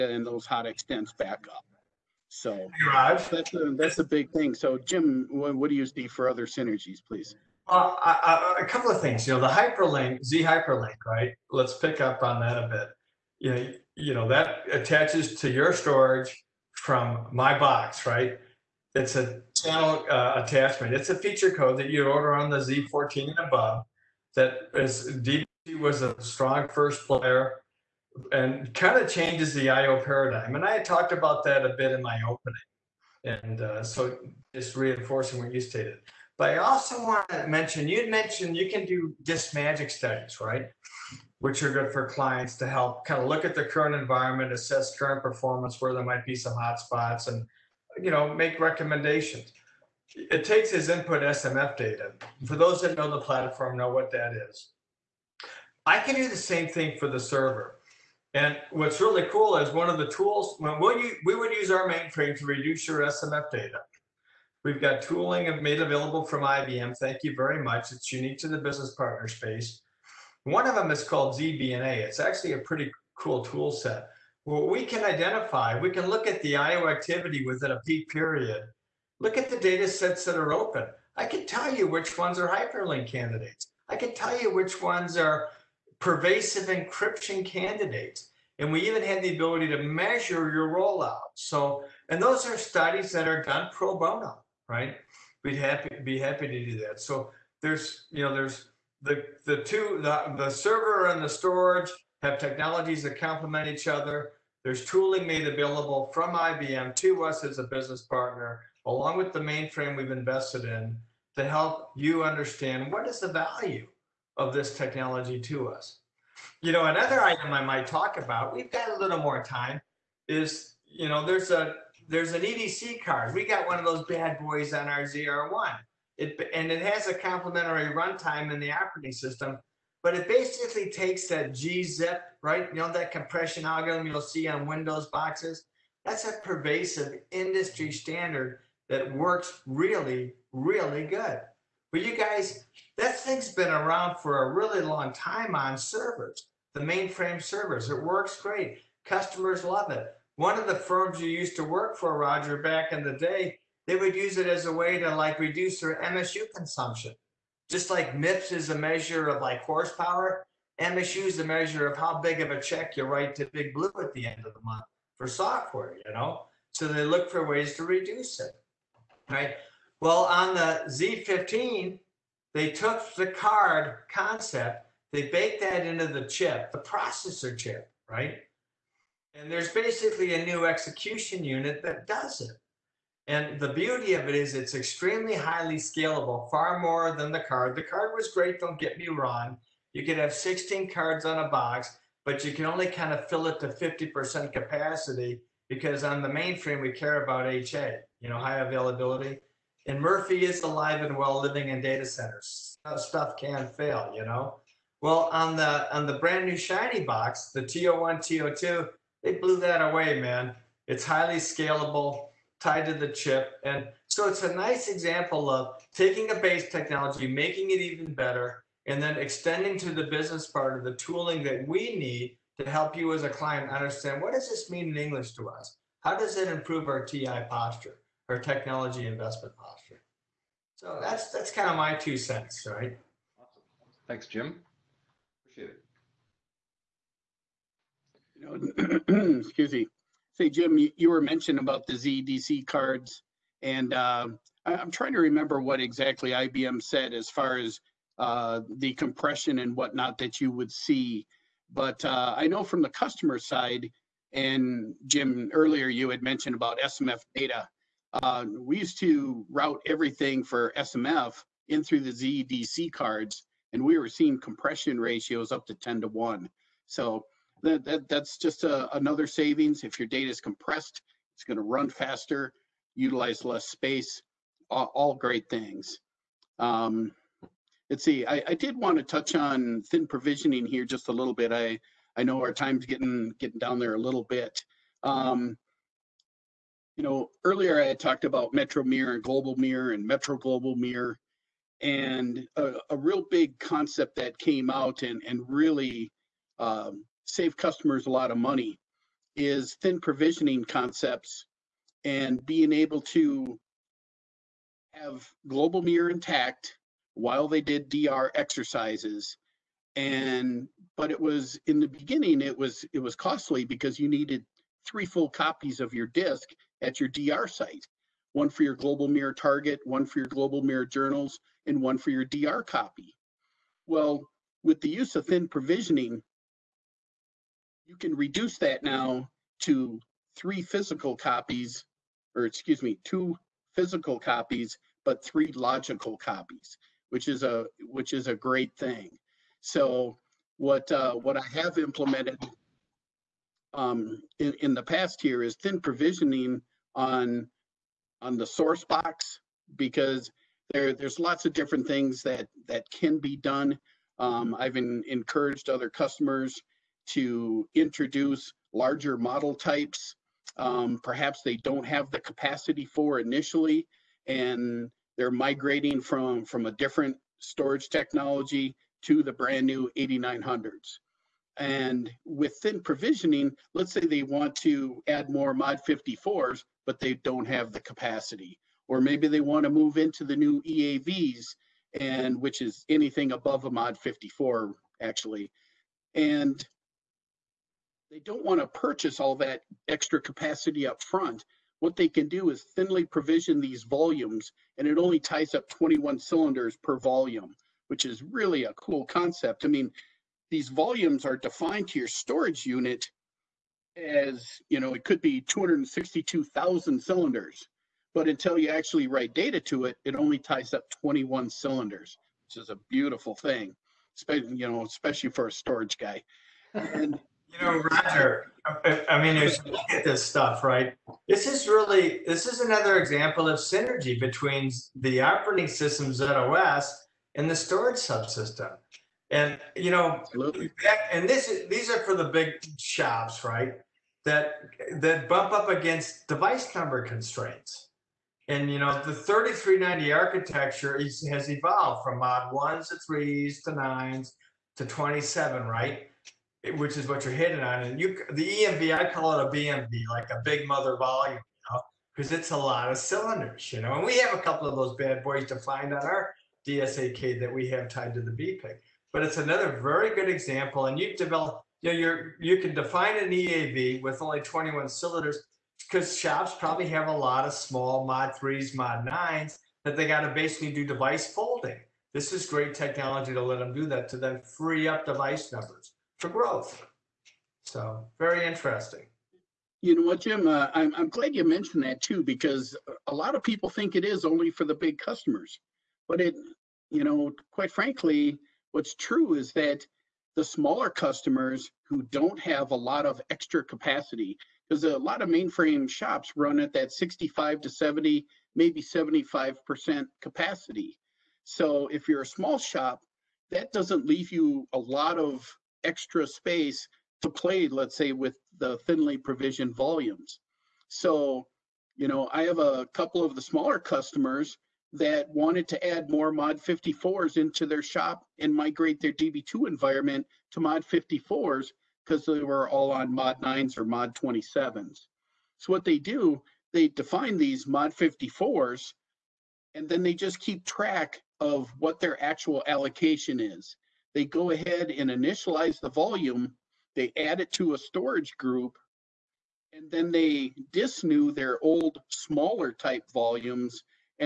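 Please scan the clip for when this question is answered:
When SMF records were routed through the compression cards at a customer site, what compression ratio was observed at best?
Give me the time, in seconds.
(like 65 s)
265 s.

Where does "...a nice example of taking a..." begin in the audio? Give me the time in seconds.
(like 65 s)
214 s.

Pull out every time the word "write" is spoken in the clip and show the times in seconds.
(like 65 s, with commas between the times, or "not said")
163 s, 409 s.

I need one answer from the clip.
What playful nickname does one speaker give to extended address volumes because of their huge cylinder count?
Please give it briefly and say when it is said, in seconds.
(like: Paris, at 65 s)
BMV, at 449 s.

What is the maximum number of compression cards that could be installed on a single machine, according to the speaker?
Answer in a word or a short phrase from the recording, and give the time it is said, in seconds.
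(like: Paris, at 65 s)
16, at 190 s.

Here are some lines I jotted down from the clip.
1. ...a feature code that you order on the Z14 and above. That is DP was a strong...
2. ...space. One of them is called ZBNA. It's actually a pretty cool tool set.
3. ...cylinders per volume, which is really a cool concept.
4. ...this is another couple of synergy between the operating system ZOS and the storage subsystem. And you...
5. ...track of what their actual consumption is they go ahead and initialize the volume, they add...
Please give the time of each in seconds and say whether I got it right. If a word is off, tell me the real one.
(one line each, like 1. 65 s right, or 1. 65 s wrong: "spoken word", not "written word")
1. 21 s right
2. 69 s right
3. 396 s right
4. 422 s wrong: "example", not "couple"
5. 530 s wrong: "allocation", not "consumption".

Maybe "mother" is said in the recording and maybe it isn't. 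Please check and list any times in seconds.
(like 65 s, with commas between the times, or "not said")
450 s.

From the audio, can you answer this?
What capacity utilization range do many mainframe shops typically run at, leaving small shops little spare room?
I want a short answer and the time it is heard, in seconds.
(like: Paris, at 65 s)
65 to 70 percent, at 496 s.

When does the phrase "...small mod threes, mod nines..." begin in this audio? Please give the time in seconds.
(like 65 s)
467 s.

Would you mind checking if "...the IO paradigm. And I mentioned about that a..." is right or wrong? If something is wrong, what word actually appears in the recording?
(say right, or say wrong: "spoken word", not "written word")
wrong: "talked", not "mentioned".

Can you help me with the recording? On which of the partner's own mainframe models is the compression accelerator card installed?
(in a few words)
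ZR1.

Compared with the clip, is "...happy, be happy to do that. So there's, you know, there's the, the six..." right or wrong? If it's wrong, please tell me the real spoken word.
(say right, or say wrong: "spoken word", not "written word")
wrong: "two", not "six".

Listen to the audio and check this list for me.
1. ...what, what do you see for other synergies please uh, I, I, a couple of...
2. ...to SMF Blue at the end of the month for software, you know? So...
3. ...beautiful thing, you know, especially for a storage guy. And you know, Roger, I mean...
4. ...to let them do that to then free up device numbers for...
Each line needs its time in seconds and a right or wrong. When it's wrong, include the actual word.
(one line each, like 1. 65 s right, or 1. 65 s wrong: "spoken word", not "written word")
1. 5 s right
2. 163 s wrong: "Big", not "SMF"
3. 412 s right
4. 473 s right.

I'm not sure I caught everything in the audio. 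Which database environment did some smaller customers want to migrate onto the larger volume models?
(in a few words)
DB2.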